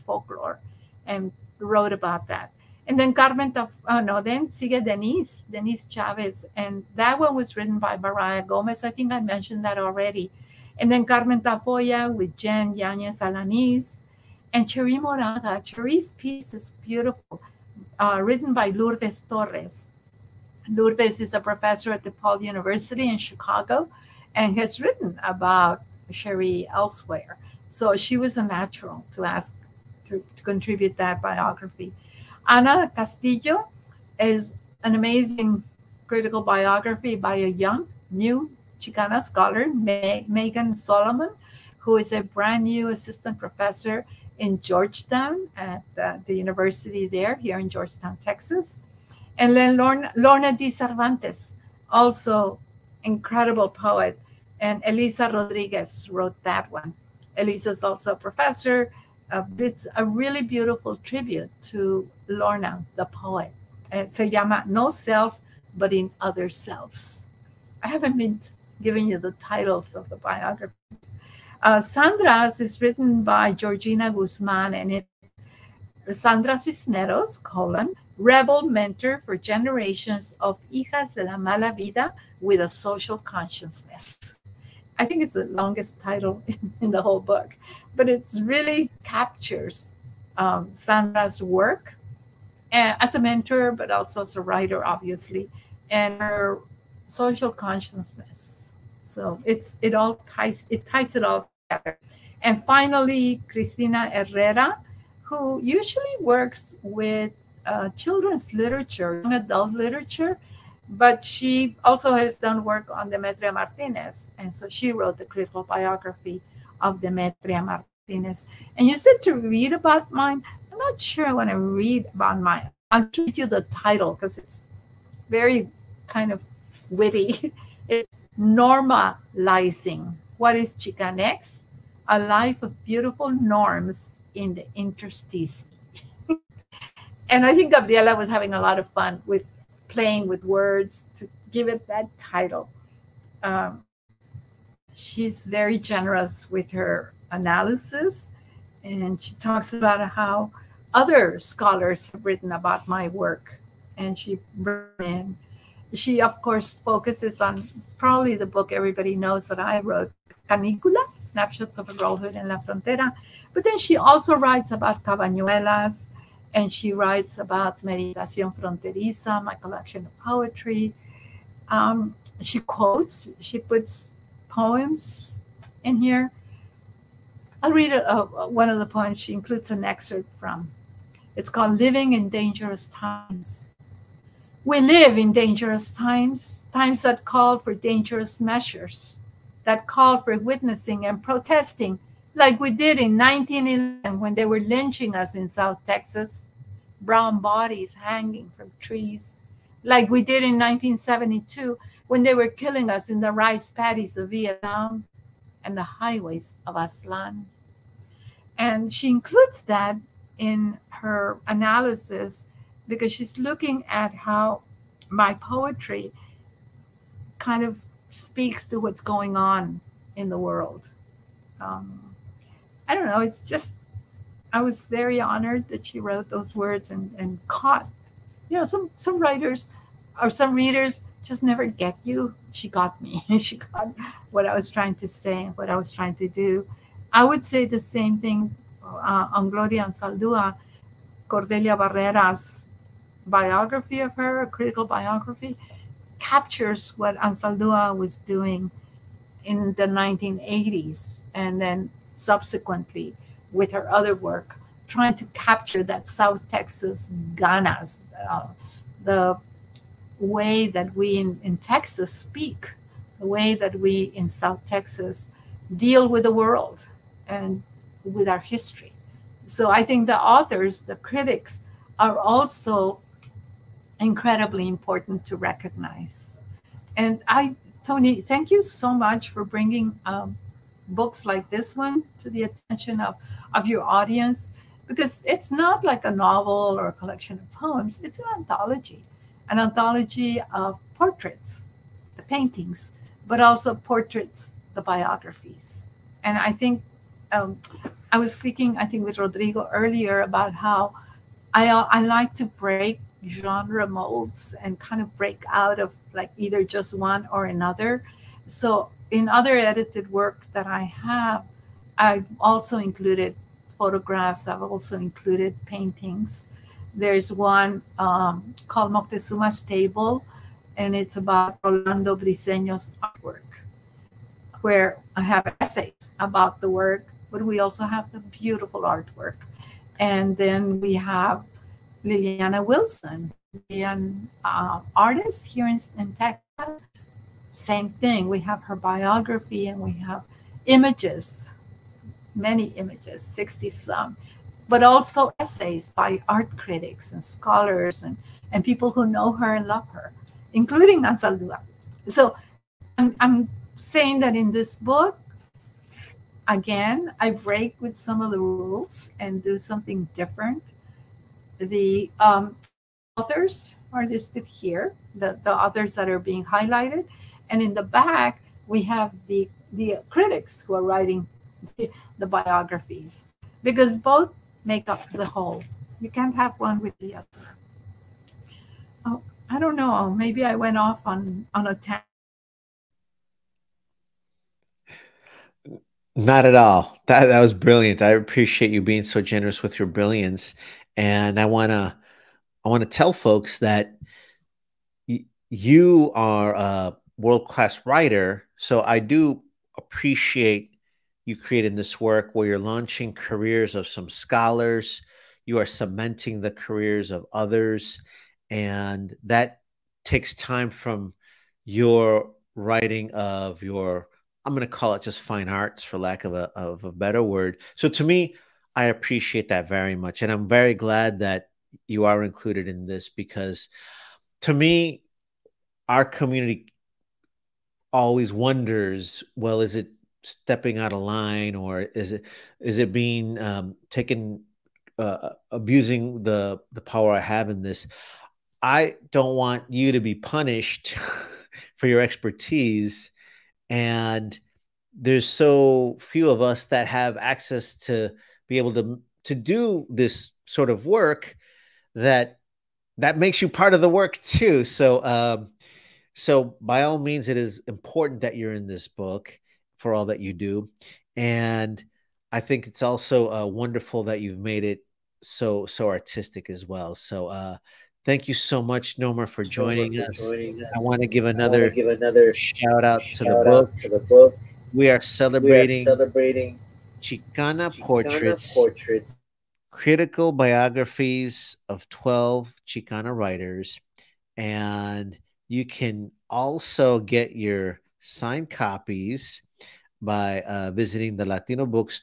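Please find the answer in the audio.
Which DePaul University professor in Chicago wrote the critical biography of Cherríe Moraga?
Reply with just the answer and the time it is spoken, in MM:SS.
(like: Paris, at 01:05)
Lourdes Torres, at 00:18.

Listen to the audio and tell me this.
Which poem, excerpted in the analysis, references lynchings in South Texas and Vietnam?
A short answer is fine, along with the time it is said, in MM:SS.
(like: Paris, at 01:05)
Living in Dangerous Times, at 03:01.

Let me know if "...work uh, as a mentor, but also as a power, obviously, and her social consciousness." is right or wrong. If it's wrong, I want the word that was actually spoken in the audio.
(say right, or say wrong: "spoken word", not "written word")
wrong: "writer", not "power".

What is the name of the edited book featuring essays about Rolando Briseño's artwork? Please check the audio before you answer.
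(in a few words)
Moctezuma's Table.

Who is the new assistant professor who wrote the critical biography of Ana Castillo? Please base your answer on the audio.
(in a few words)
Megan Solomon.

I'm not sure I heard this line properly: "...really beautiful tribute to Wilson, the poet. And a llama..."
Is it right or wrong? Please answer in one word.
wrong.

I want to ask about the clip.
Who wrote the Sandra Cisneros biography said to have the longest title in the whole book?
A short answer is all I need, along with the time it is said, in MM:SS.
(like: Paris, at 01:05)
Georgina Guzman, at 01:13.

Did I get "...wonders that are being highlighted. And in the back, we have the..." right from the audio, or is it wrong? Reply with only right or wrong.
wrong.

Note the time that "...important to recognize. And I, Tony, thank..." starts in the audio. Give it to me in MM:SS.
04:34.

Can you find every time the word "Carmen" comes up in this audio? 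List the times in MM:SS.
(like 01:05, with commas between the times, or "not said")
00:03, 00:11.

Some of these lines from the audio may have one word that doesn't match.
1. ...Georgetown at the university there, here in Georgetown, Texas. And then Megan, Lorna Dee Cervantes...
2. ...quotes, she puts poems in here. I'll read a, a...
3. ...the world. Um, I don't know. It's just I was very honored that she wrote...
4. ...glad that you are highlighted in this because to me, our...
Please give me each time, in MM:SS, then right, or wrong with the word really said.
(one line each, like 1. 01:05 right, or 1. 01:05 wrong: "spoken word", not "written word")
1. 00:44 wrong: "Lorna", not "Megan"
2. 02:52 right
3. 03:40 right
4. 07:00 wrong: "included", not "highlighted".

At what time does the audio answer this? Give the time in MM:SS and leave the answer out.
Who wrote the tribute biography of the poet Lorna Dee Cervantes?
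00:54.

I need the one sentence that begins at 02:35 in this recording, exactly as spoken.
She, of course, focuses on probably the book everybody knows that I wrote, Canicula, Snapshots of a Girlhood in La Frontera.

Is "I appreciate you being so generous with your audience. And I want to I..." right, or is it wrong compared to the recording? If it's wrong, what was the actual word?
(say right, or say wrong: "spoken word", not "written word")
wrong: "brilliance", not "audience".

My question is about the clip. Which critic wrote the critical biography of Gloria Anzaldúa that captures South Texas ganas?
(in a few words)
Cordelia Barrera.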